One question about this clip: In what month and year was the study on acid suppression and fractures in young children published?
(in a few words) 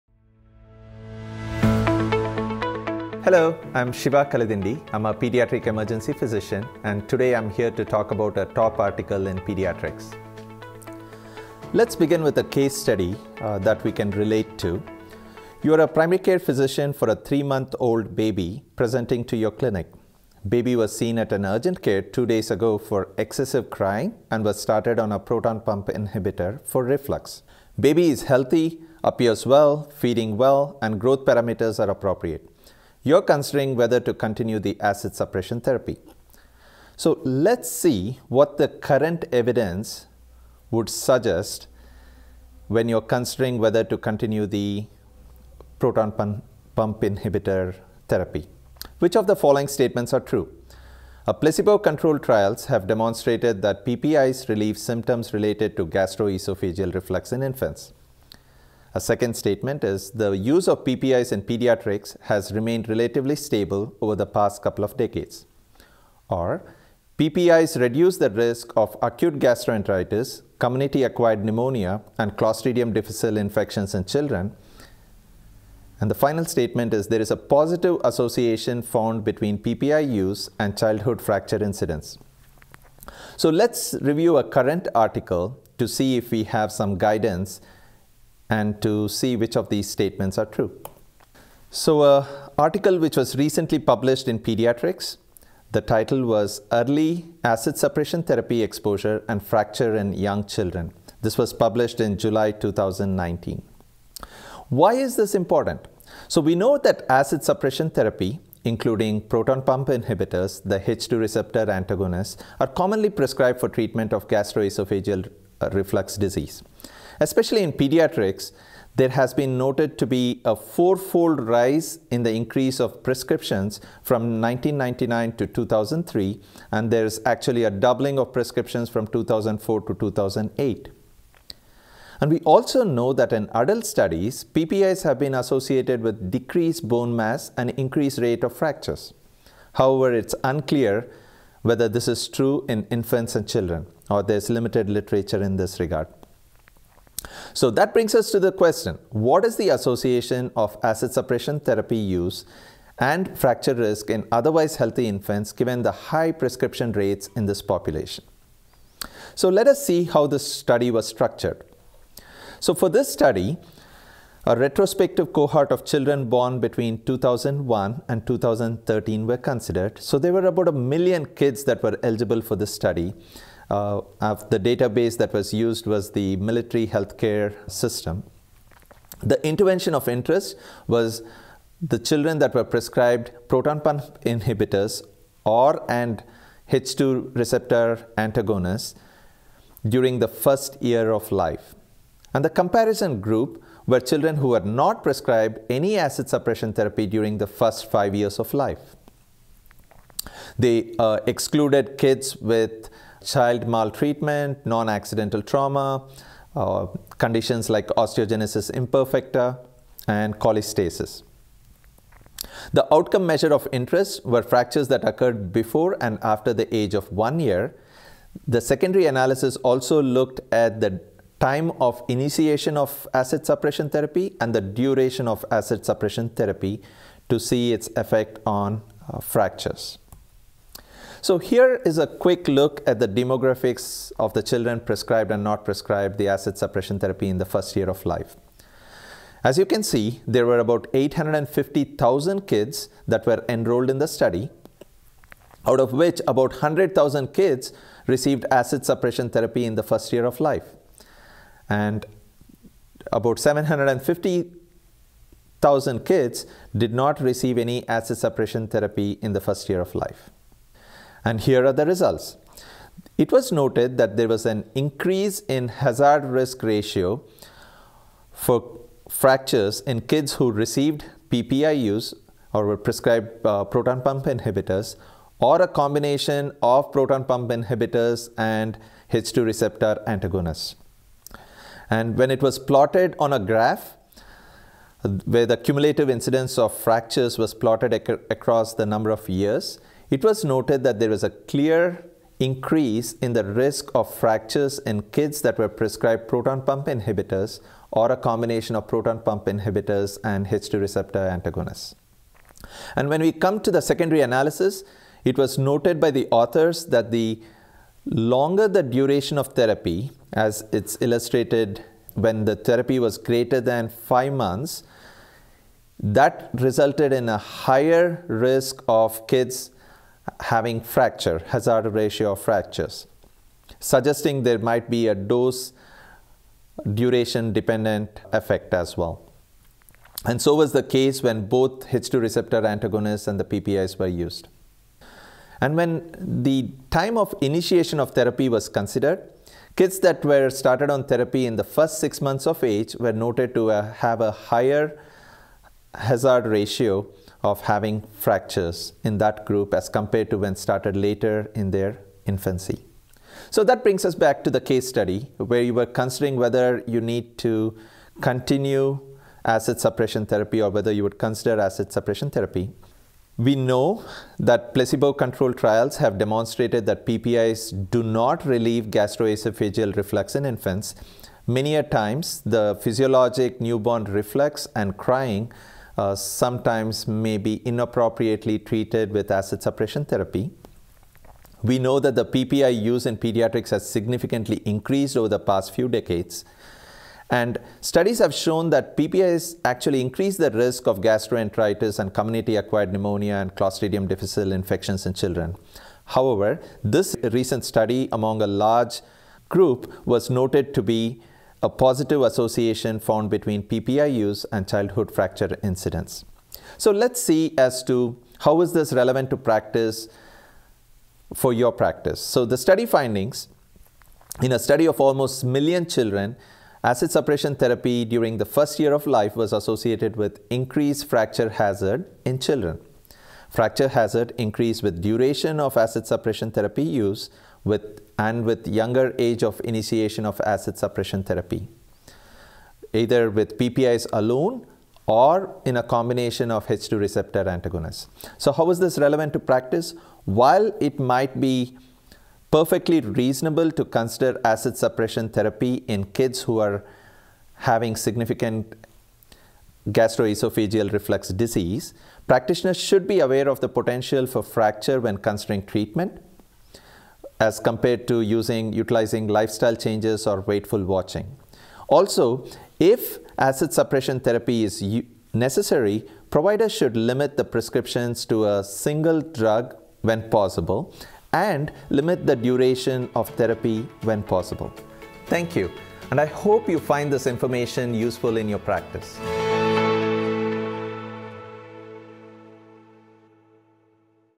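July 2019.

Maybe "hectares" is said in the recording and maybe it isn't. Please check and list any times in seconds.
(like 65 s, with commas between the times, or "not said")
not said.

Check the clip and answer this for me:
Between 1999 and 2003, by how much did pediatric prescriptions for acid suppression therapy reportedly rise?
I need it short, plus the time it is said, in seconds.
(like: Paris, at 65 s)
fourfold, at 120 s.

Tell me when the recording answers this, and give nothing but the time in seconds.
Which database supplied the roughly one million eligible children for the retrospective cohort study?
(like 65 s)
176 s.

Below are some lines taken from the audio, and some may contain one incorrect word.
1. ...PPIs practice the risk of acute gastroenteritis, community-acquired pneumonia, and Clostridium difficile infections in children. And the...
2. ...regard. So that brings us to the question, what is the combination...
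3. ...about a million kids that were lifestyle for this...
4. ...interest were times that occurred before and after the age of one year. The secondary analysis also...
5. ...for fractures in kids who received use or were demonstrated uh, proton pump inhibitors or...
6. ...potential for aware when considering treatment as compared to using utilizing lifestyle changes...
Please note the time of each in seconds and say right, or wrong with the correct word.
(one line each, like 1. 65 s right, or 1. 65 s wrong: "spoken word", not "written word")
1. 67 s wrong: "reduce", not "practice"
2. 145 s wrong: "association", not "combination"
3. 170 s wrong: "eligible", not "lifestyle"
4. 213 s wrong: "fractures", not "times"
5. 268 s wrong: "prescribed", not "demonstrated"
6. 453 s wrong: "fracture", not "aware".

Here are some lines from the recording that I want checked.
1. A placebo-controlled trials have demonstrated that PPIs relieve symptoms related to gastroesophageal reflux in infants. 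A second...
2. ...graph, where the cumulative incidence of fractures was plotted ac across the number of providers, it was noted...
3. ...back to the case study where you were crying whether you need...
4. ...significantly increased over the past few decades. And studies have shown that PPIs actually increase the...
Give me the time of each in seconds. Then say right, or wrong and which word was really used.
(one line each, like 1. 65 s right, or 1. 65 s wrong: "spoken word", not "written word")
1. 51 s right
2. 283 s wrong: "years", not "providers"
3. 354 s wrong: "considering", not "crying"
4. 383 s right.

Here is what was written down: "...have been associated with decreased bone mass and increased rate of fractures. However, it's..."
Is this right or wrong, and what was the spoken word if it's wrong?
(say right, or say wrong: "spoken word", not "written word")
right.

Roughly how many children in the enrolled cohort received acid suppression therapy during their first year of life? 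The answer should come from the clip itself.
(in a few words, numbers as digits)
100,000.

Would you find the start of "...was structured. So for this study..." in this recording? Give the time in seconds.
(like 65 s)
160 s.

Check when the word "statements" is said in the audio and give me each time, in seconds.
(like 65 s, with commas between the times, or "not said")
49 s, 59 s, 76 s, 89 s.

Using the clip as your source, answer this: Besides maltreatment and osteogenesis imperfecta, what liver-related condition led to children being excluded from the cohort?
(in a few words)
cholestasis.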